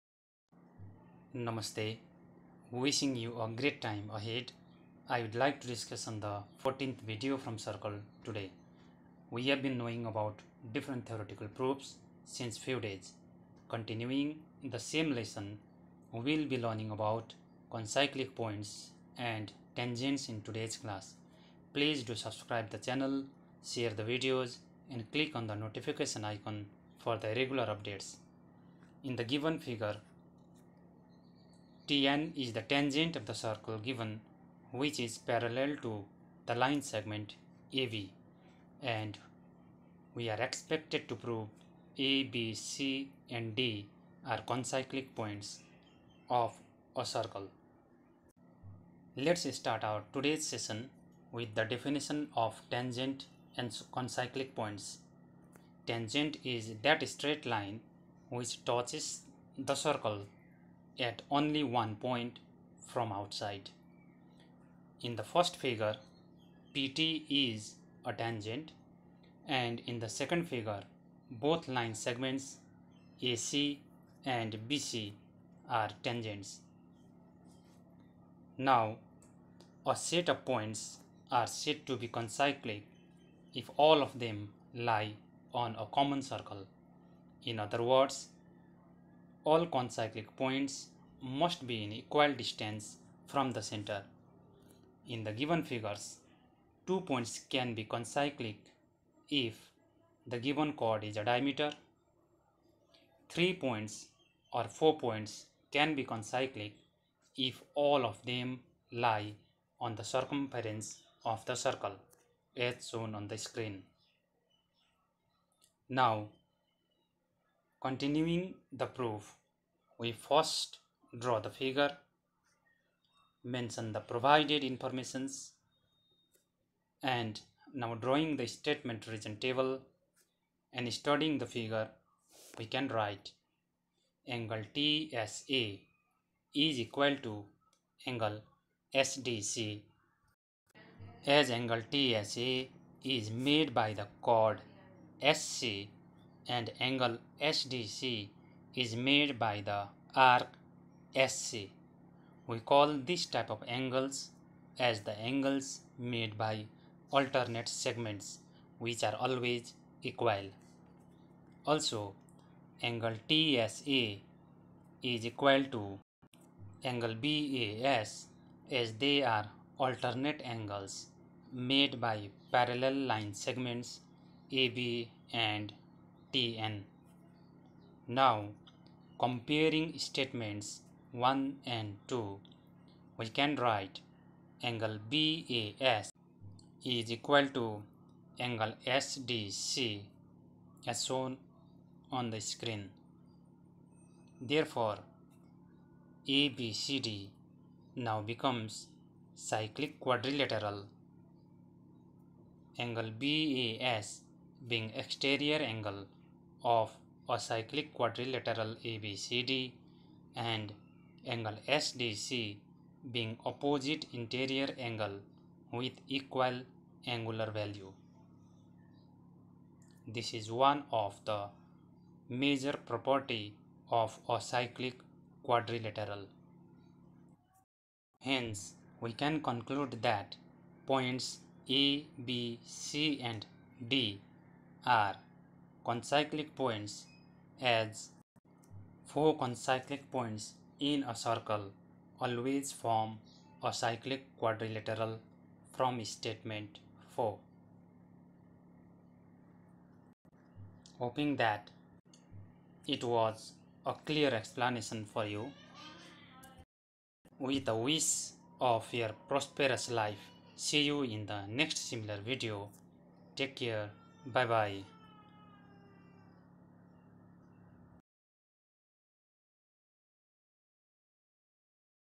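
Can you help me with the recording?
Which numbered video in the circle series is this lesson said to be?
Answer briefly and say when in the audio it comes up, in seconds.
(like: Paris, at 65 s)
14th, at 6 s.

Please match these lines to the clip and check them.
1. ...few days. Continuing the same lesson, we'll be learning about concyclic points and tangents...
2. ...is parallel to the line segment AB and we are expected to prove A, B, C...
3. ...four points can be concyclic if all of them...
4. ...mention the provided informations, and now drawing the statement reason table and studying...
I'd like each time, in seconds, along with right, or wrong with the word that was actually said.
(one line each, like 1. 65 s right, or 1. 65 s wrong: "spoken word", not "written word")
1. 12 s right
2. 34 s right
3. 104 s right
4. 123 s right.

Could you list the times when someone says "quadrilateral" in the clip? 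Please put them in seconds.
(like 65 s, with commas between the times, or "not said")
200 s, 207 s, 225 s, 244 s.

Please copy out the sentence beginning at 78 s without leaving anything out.
Now, a set of points are said to be concyclic if all of them lie on a common circle.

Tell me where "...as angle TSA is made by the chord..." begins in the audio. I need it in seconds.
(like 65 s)
141 s.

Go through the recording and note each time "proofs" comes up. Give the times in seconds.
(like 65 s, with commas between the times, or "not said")
11 s, 118 s.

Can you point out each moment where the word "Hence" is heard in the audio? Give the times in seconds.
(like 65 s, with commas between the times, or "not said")
228 s.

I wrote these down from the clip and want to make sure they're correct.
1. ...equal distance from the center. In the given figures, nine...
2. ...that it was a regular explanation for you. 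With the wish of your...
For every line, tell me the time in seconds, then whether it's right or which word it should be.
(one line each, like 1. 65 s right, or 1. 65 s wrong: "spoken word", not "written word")
1. 91 s wrong: "two", not "nine"
2. 251 s wrong: "clear", not "regular".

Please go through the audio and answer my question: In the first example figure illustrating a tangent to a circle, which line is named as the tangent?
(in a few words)
PT.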